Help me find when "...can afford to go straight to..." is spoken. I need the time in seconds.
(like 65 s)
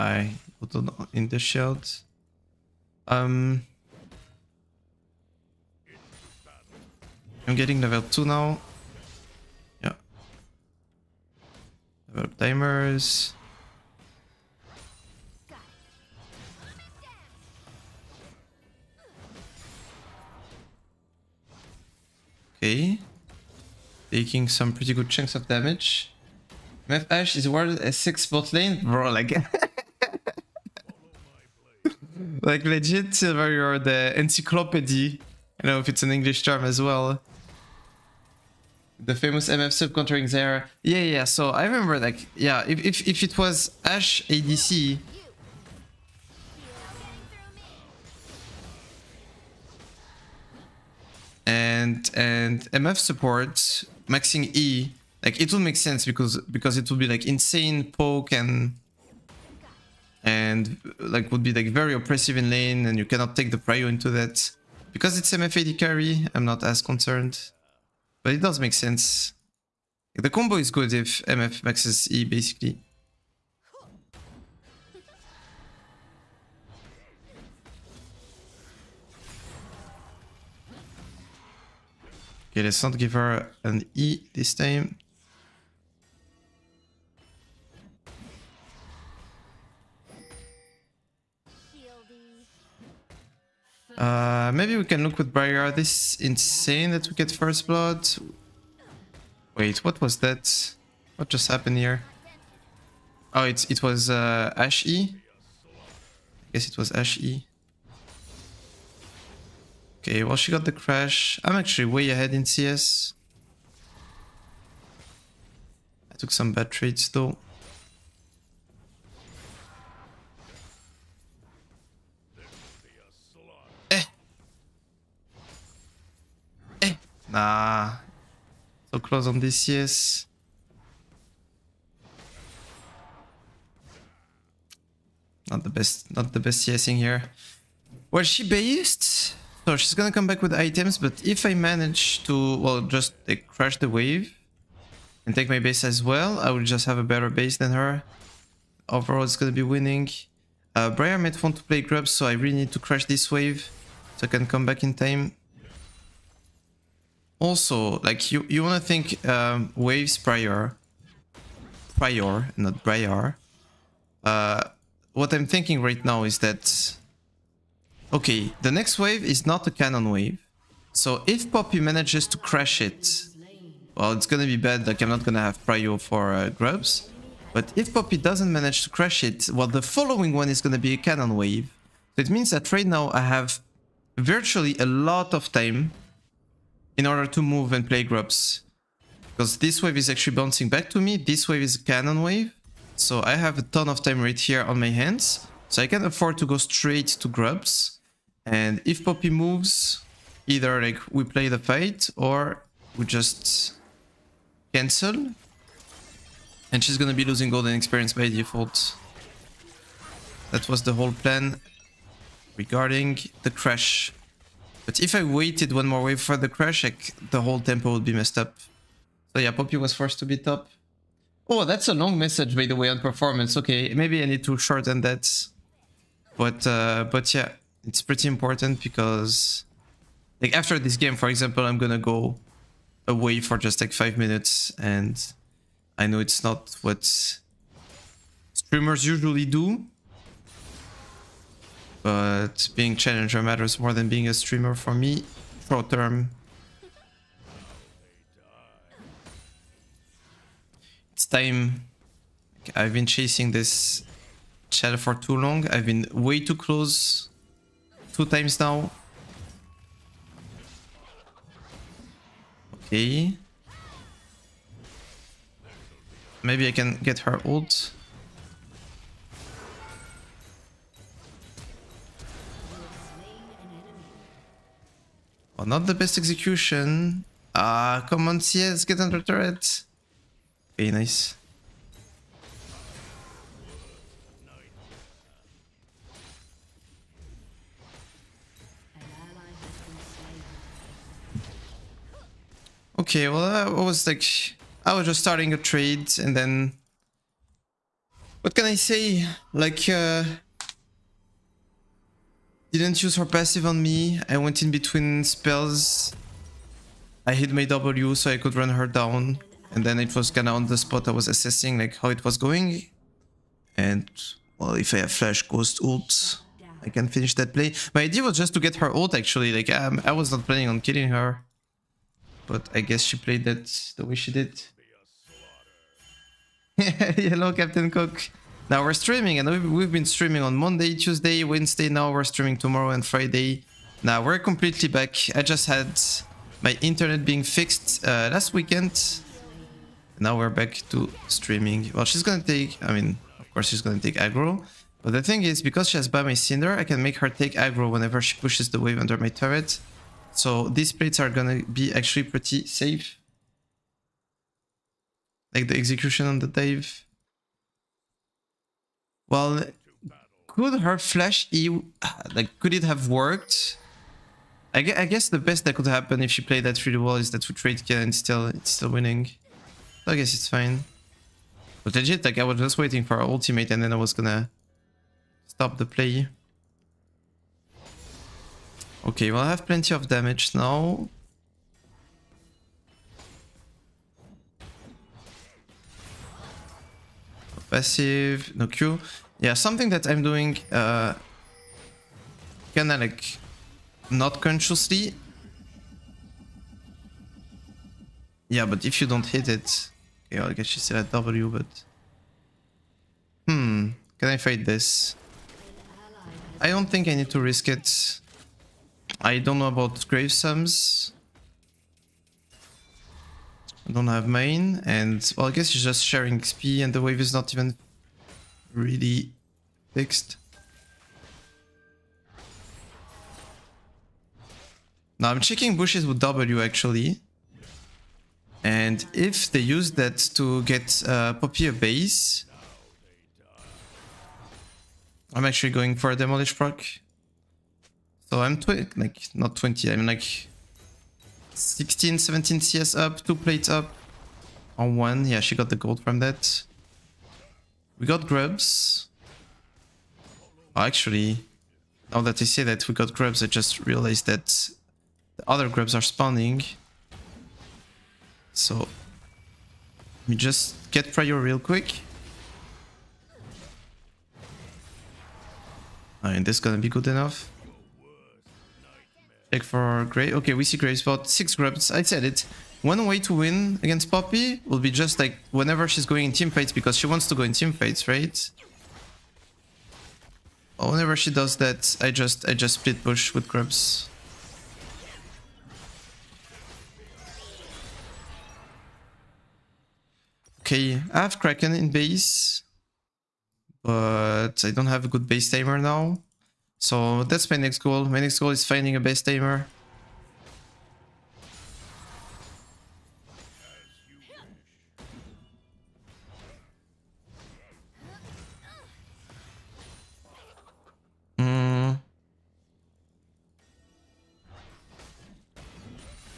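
195 s.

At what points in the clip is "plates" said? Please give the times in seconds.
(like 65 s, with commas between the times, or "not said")
350 s, 443 s.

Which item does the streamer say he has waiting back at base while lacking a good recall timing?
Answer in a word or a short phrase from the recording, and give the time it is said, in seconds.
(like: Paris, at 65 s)
Kraken, at 491 s.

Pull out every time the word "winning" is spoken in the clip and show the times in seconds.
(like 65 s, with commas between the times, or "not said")
149 s, 368 s.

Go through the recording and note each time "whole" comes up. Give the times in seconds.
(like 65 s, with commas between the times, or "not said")
210 s, 217 s.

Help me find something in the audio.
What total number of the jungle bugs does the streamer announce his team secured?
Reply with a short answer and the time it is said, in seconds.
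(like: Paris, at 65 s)
6, at 471 s.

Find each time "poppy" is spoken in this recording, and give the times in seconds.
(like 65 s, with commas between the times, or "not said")
171 s, 177 s, 199 s, 219 s, 431 s, 474 s.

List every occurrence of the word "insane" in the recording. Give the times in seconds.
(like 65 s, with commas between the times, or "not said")
57 s, 96 s.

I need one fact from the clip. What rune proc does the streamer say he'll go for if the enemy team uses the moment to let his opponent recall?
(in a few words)
Demolish.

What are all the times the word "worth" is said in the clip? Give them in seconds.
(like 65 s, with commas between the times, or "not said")
27 s.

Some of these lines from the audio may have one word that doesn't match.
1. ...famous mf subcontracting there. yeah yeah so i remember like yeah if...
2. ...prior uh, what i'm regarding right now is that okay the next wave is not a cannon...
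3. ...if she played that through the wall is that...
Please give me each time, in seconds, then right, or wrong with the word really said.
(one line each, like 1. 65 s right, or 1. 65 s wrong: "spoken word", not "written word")
1. 39 s right
2. 162 s wrong: "thinking", not "regarding"
3. 366 s right.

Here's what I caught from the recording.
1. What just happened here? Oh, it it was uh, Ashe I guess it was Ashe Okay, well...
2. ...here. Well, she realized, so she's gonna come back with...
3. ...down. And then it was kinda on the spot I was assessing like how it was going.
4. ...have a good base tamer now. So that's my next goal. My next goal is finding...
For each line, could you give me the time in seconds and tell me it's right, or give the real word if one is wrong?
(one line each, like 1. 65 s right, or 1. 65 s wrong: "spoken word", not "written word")
1. 101 s right
2. 136 s wrong: "based", not "realized"
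3. 309 s right
4. 494 s wrong: "timer", not "tamer".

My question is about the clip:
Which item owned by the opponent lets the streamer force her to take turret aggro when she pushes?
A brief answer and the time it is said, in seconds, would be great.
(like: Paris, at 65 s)
Bami's Cinder, at 346 s.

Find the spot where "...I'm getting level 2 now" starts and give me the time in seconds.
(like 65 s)
7 s.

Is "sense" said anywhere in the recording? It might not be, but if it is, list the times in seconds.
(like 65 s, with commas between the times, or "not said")
55 s, 68 s.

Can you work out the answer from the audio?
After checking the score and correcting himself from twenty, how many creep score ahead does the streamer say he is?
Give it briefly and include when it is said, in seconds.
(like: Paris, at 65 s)
16-17, at 439 s.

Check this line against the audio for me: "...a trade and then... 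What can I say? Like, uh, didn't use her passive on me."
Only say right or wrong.
right.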